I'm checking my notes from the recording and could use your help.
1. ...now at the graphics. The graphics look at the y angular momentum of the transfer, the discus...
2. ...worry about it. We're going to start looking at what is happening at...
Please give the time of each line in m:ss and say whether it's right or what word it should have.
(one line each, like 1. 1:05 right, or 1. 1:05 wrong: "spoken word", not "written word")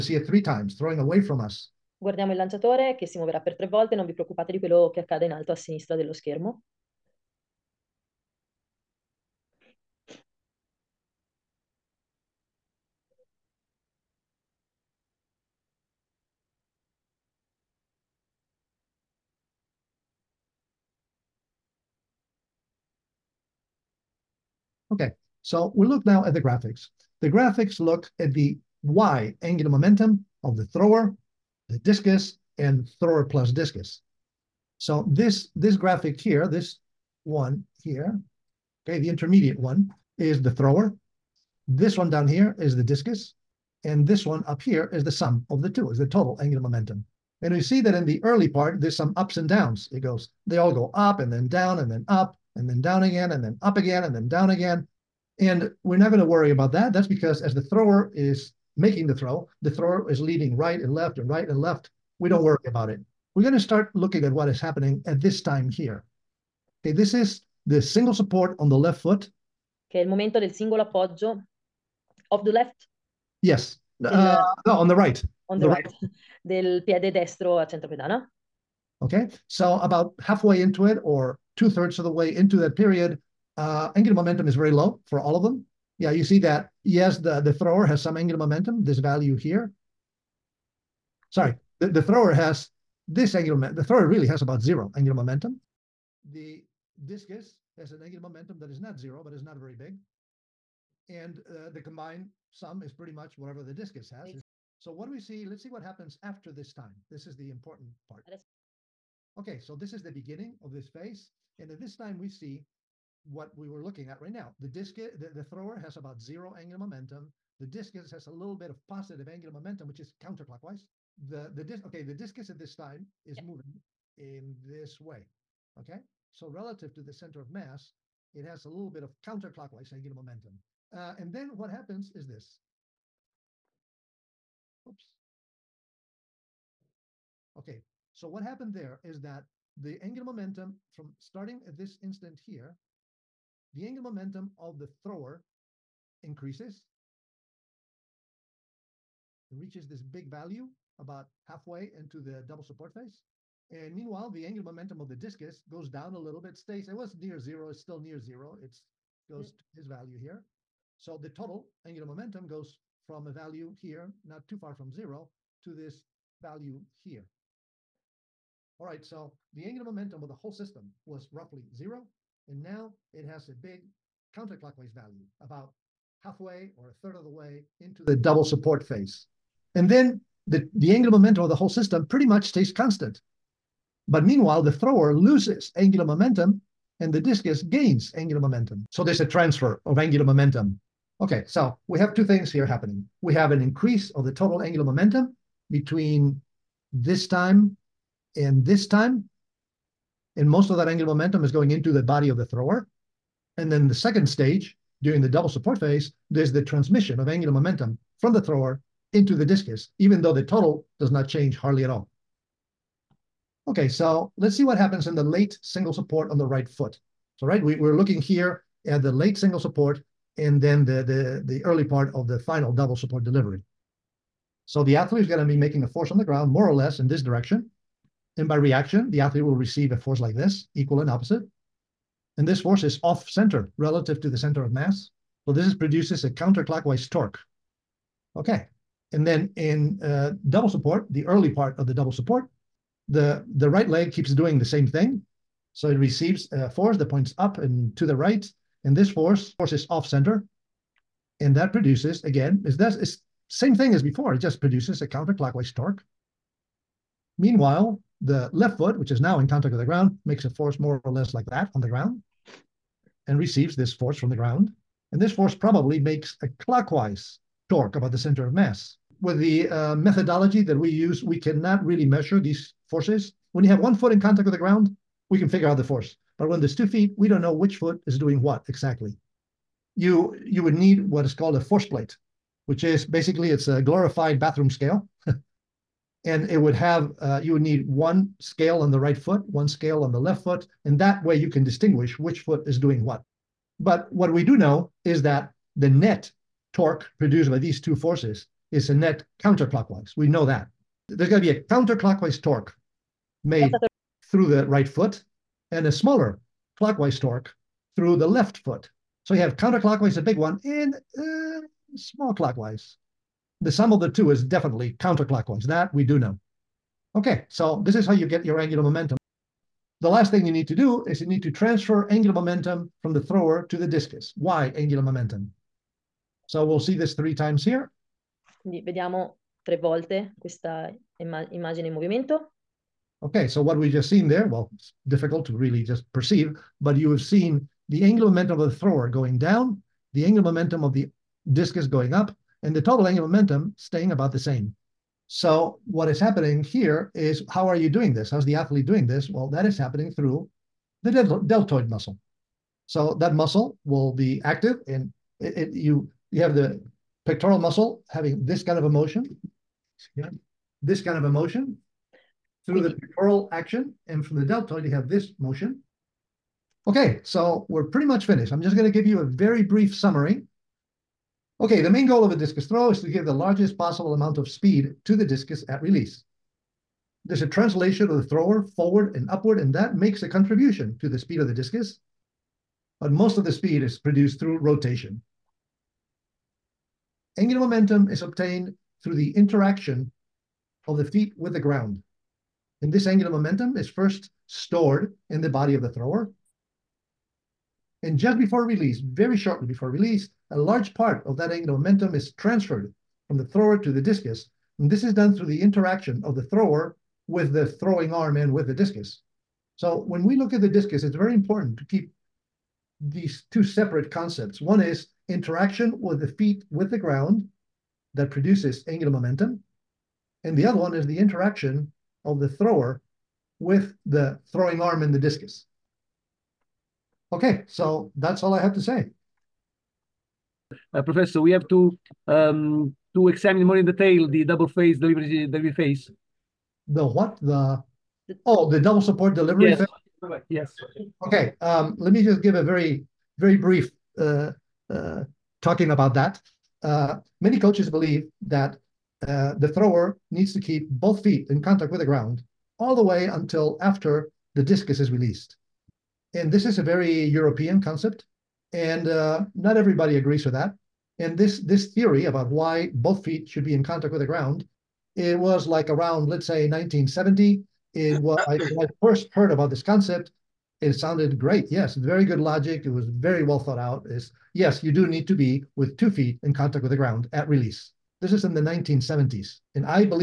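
1. 0:26 wrong: "thrower", not "transfer"
2. 1:02 right.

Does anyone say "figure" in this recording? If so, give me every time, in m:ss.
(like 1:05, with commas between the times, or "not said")
4:35.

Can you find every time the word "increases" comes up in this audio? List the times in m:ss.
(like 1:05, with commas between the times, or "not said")
2:26, 3:13.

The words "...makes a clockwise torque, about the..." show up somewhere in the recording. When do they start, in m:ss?
4:25.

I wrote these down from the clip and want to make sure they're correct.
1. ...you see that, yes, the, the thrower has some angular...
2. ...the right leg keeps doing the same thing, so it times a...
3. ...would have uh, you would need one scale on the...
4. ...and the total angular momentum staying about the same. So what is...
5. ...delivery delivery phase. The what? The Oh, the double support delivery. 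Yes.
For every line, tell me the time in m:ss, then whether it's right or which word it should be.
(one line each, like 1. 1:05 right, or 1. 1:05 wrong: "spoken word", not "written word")
1. 1:26 right
2. 4:03 wrong: "receives", not "times"
3. 4:46 right
4. 5:42 right
5. 7:14 right.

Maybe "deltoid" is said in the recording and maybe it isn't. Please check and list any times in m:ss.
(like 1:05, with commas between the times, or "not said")
5:51, 6:04.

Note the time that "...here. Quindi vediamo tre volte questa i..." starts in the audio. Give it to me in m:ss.
5:27.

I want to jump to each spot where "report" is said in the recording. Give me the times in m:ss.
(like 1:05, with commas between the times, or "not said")
not said.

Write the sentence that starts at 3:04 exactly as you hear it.
But meanwhile, the thrower loses angular momentum and the discus gains angular momentum.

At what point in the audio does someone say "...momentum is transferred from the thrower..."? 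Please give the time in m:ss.
6:41.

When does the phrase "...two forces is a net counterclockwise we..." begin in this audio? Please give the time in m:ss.
4:57.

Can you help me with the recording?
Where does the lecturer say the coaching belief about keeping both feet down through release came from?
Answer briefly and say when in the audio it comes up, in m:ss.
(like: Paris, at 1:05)
European, at 7:36.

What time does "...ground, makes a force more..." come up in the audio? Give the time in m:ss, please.
4:19.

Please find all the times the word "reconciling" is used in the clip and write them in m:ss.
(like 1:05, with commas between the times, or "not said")
not said.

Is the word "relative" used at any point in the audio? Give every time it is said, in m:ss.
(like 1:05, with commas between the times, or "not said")
2:06, 3:53.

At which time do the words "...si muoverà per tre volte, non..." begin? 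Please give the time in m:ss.
0:03.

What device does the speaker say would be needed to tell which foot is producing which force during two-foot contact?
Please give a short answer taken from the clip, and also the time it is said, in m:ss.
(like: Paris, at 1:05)
A force plate, at 4:41.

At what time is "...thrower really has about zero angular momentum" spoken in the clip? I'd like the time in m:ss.
1:33.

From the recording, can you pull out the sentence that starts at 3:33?
Okay, so let's see what happens in the late single support on the right foot.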